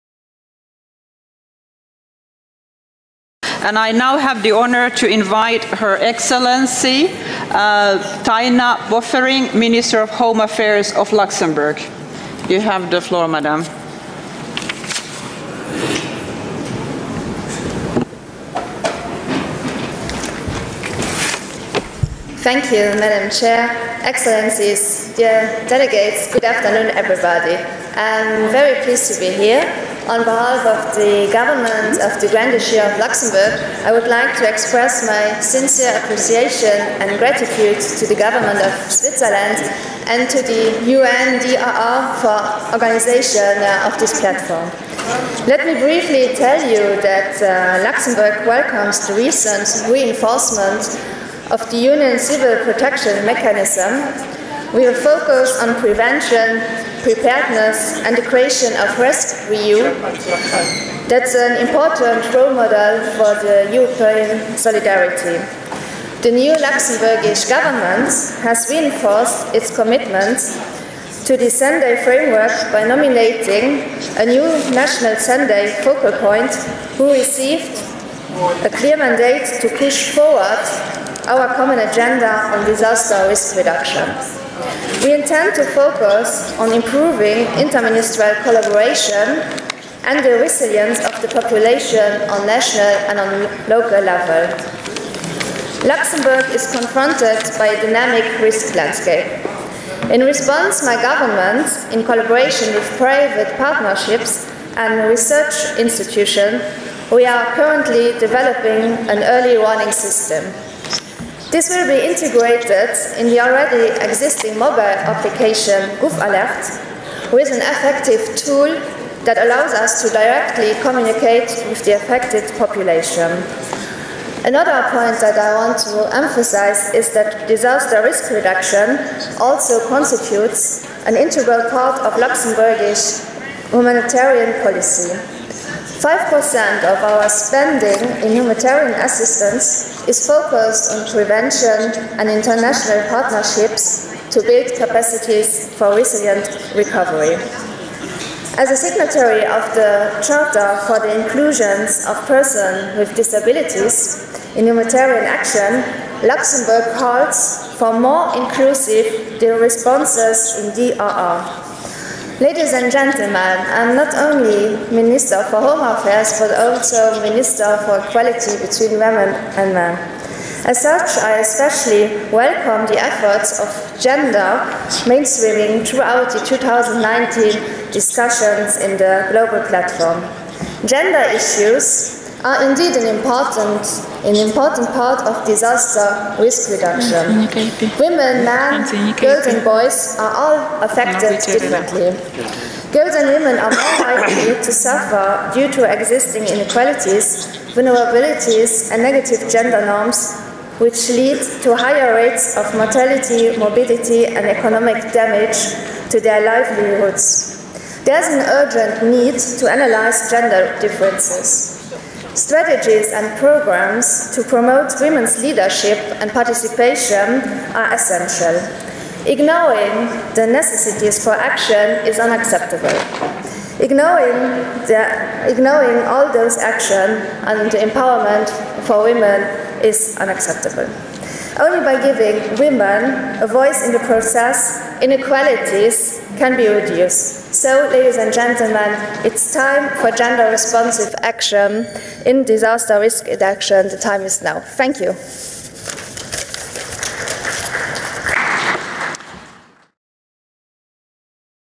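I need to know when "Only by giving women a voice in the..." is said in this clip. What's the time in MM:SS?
03:51.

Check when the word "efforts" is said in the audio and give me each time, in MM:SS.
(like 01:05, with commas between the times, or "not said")
02:52.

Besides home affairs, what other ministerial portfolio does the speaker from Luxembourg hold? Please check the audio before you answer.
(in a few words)
Equality between Women and Men.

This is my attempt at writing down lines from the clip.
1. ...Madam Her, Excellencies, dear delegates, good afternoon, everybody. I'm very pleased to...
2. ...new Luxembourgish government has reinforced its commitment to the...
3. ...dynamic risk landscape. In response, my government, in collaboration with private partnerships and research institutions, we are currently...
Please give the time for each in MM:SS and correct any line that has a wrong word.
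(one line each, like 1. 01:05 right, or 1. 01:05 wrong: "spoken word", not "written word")
1. 00:22 wrong: "Chair", not "Her"
2. 01:06 right
3. 01:37 right.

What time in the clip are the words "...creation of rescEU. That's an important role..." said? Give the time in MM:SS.
00:58.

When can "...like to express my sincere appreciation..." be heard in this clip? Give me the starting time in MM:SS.
00:34.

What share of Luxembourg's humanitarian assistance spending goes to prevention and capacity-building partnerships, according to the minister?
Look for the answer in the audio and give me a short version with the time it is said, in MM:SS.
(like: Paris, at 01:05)
5%, at 02:16.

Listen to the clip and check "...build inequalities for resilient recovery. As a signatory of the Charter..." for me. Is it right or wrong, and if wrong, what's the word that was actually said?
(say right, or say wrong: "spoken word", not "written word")
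wrong: "capacities", not "inequalities".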